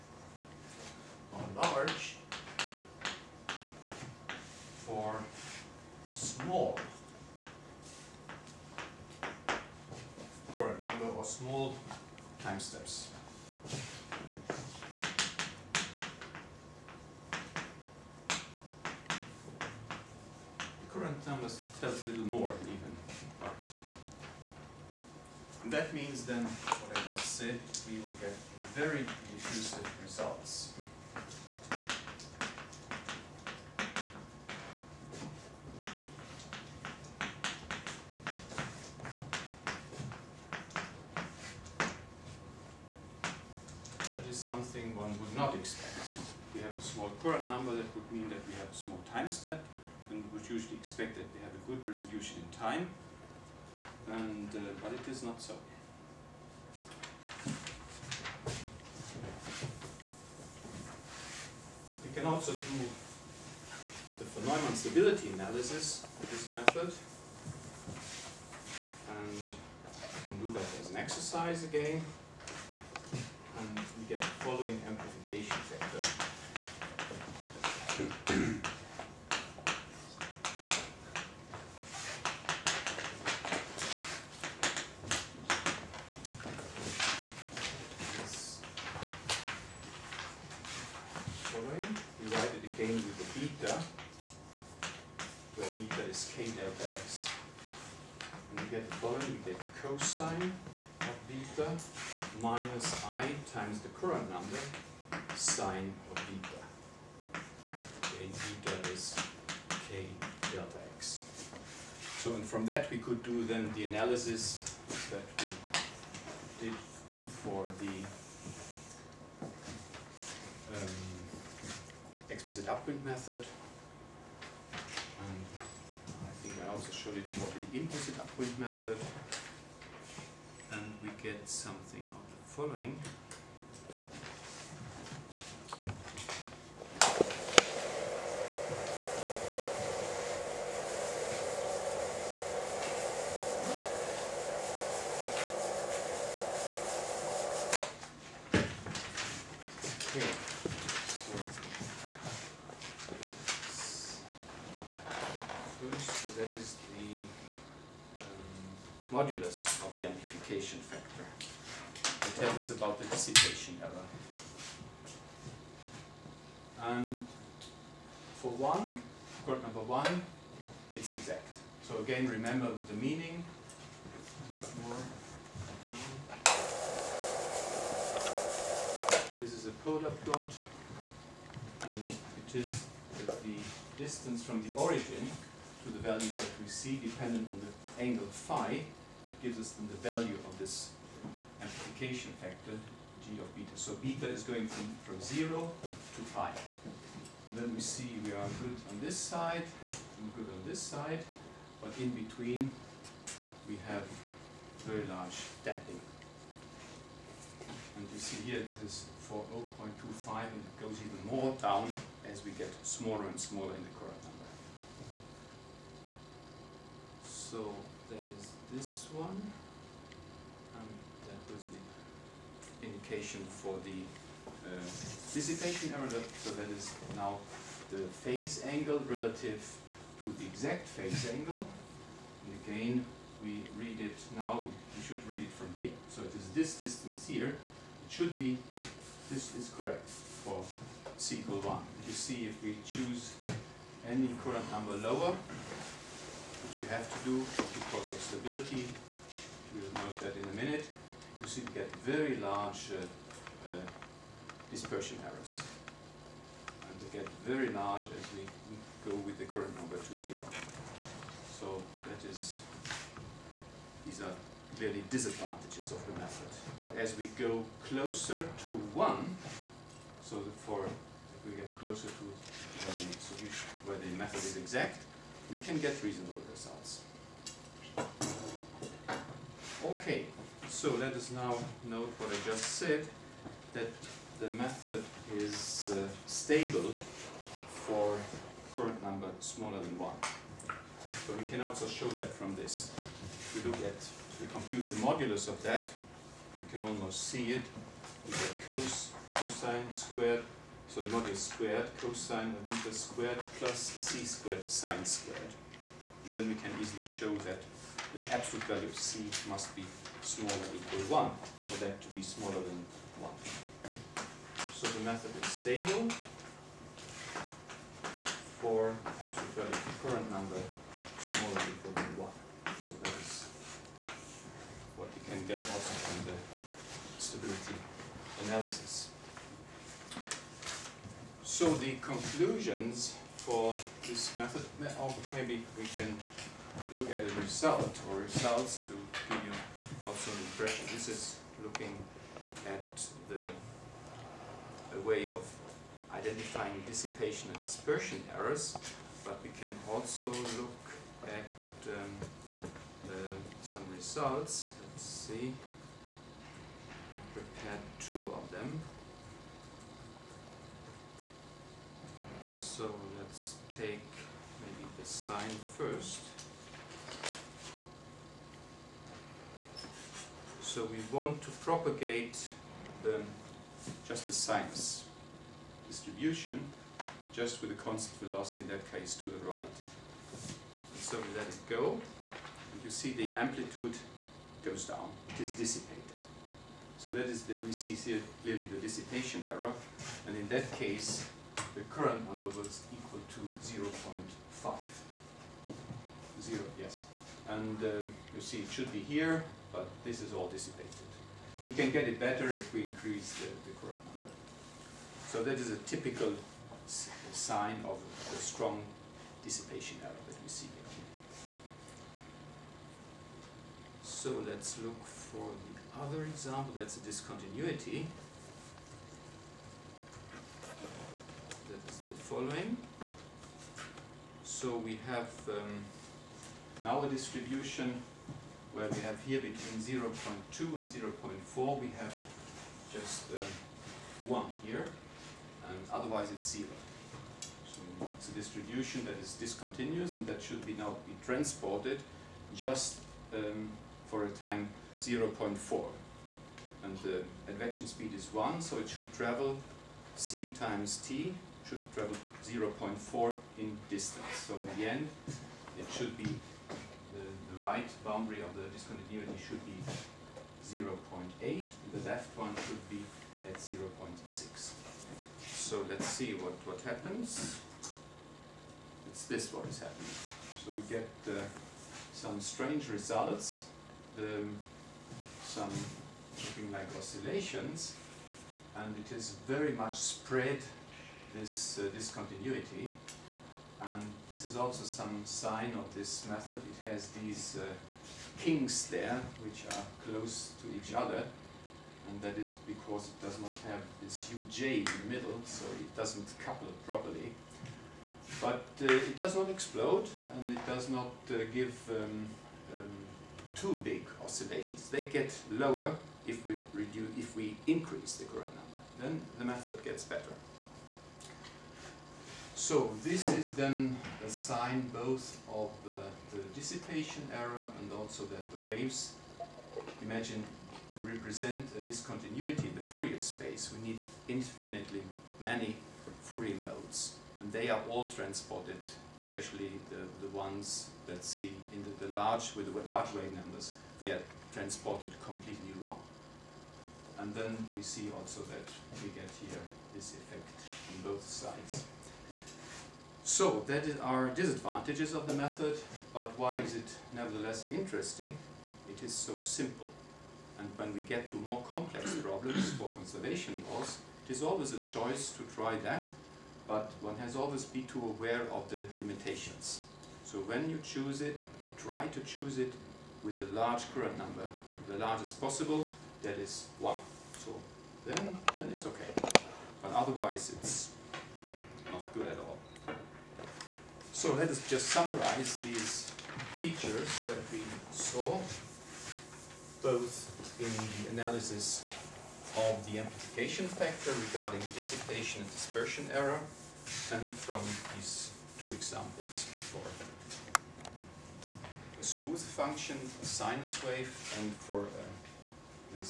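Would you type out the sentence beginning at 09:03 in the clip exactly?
So that are disadvantages of the method, but why is it nevertheless interesting?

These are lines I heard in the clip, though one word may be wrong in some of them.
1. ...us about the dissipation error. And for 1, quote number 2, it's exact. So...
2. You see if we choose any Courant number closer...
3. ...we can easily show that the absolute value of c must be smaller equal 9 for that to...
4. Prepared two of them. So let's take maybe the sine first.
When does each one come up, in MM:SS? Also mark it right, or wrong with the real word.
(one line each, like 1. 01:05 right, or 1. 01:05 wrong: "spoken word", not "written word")
1. 02:42 wrong: "1", not "2"
2. 04:02 wrong: "lower", not "closer"
3. 05:06 wrong: "1", not "9"
4. 05:57 right.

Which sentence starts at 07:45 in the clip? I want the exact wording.
So let's see what, what happens.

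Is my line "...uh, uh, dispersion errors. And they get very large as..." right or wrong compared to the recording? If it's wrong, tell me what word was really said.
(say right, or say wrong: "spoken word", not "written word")
right.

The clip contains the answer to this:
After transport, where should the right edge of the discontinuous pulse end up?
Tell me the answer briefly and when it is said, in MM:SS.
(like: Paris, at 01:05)
0.8, at 07:40.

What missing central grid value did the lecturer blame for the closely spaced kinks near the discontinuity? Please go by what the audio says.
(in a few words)
UJ.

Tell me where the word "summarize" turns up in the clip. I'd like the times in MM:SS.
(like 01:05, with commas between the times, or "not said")
09:34.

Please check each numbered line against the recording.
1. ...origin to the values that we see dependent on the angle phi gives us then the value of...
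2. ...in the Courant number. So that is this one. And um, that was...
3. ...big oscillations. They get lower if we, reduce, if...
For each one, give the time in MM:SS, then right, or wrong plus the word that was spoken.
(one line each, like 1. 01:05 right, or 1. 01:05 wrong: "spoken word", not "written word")
1. 03:04 right
2. 03:33 right
3. 08:23 right.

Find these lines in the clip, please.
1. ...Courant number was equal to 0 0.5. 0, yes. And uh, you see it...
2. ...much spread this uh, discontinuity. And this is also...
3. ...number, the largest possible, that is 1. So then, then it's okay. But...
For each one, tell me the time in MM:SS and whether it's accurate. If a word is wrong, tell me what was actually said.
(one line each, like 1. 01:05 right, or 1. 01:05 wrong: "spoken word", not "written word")
1. 06:31 right
2. 07:59 right
3. 09:24 right.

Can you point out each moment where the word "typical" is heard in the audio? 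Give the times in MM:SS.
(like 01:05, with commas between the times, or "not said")
06:45.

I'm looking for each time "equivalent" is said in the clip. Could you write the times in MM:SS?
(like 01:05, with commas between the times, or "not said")
not said.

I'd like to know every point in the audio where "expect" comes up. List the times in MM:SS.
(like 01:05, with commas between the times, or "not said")
00:45, 00:50.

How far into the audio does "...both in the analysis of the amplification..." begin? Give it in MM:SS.
09:39.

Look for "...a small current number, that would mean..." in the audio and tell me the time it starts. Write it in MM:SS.
00:46.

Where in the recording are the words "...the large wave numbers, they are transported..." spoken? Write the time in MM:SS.
08:52.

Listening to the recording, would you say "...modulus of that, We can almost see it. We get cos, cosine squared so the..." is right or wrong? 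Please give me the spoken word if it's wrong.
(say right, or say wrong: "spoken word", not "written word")
right.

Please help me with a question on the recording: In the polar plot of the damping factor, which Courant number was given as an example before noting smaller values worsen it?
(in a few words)
0.25.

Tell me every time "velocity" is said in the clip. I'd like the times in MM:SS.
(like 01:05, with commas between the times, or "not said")
06:18.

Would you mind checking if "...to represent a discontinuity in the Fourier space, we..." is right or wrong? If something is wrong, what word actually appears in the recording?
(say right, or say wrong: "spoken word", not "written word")
right.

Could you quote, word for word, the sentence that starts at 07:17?
So it's a distribution that is discontinuous and that should be now be transported just um, for a time 0.4.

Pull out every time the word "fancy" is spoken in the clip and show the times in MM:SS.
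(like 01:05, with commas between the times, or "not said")
not said.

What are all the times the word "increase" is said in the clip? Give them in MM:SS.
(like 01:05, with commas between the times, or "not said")
06:42, 08:27.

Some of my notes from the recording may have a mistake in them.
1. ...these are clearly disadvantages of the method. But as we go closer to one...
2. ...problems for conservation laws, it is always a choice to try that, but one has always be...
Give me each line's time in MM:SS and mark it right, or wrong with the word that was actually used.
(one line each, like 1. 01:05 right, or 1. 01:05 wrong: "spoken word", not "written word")
1. 04:24 right
2. 09:12 right.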